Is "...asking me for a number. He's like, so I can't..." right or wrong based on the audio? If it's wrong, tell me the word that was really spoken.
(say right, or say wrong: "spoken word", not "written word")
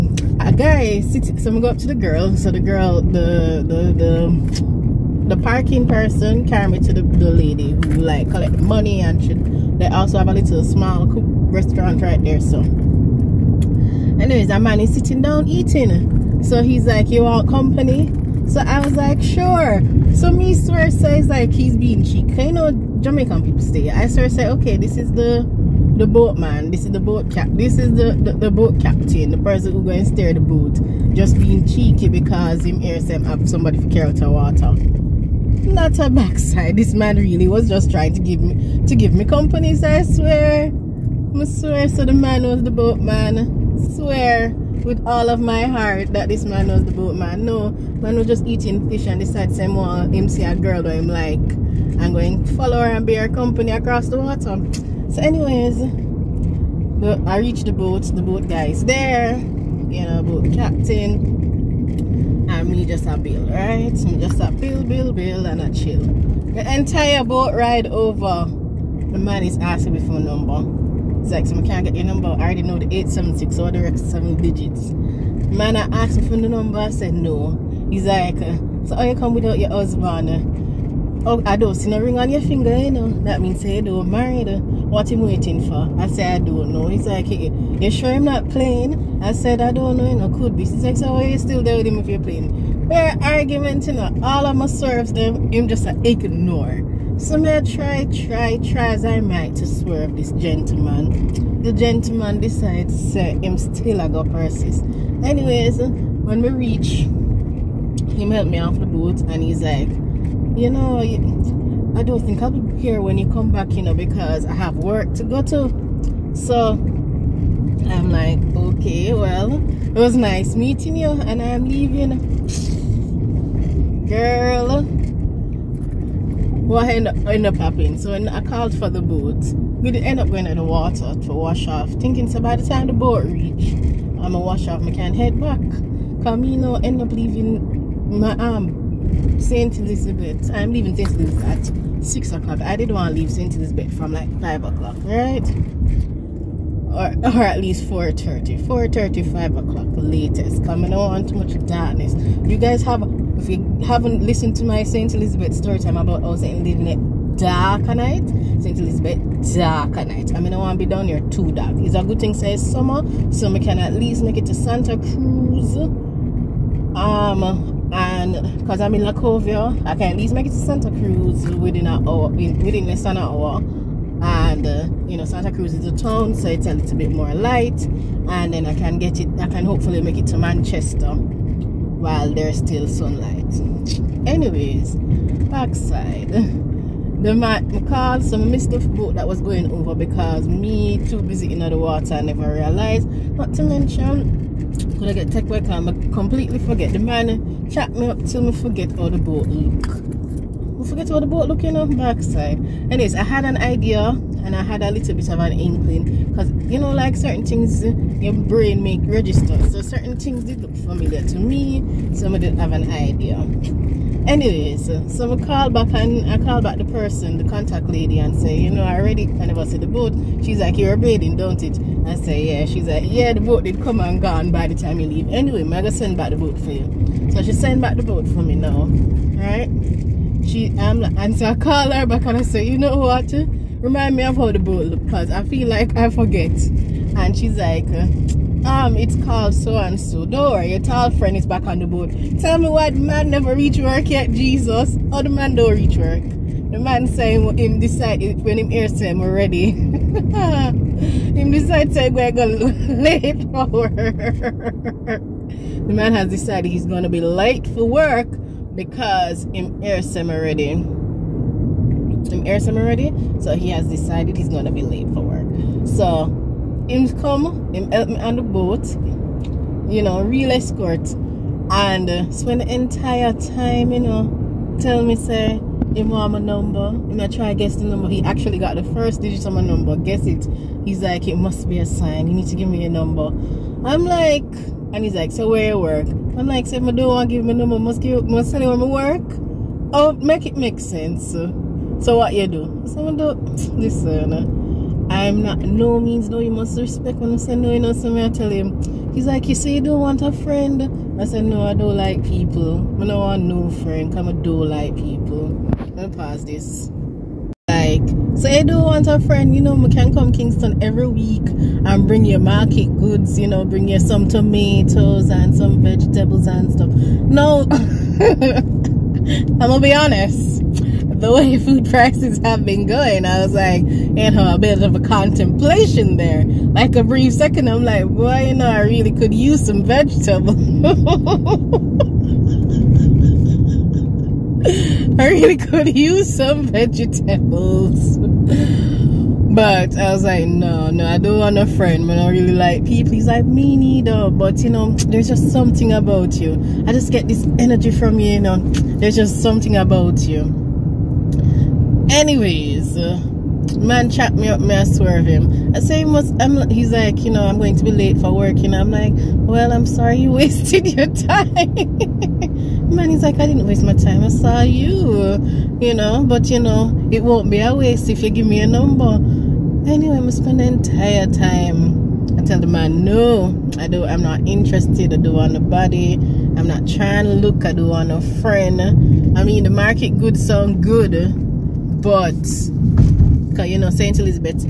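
right.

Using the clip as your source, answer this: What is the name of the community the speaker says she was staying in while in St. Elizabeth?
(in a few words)
Lacovia.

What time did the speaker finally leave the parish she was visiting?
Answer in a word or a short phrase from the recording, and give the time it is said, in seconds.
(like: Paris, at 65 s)
6 o'clock, at 142 s.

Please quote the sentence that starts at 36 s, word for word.
This man really was just trying to give me to give me companies, I swear.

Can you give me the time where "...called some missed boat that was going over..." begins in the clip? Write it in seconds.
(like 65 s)
187 s.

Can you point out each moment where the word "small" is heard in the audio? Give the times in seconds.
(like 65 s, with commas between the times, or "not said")
10 s.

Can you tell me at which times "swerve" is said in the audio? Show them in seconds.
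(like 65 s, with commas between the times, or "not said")
99 s, 354 s.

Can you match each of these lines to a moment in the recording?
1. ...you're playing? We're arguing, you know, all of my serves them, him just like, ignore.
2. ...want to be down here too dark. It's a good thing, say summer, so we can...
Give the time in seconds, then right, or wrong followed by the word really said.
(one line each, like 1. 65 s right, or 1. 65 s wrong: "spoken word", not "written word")
1. 92 s right
2. 160 s right.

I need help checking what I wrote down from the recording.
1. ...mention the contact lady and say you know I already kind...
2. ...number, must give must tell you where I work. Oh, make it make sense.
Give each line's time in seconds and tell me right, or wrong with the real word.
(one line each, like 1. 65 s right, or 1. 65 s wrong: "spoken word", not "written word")
1. 216 s wrong: "person", not "mention"
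2. 287 s right.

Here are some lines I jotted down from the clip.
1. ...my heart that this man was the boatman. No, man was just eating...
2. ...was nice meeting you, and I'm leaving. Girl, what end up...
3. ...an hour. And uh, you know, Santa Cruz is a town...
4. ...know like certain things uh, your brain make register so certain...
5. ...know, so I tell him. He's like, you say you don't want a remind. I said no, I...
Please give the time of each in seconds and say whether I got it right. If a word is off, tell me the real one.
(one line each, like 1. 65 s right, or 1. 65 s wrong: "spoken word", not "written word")
1. 45 s right
2. 119 s right
3. 173 s right
4. 206 s right
5. 297 s wrong: "friend", not "remind".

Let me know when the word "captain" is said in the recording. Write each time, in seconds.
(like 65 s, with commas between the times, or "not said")
28 s, 60 s.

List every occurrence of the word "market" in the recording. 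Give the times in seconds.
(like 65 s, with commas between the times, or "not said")
312 s, 379 s.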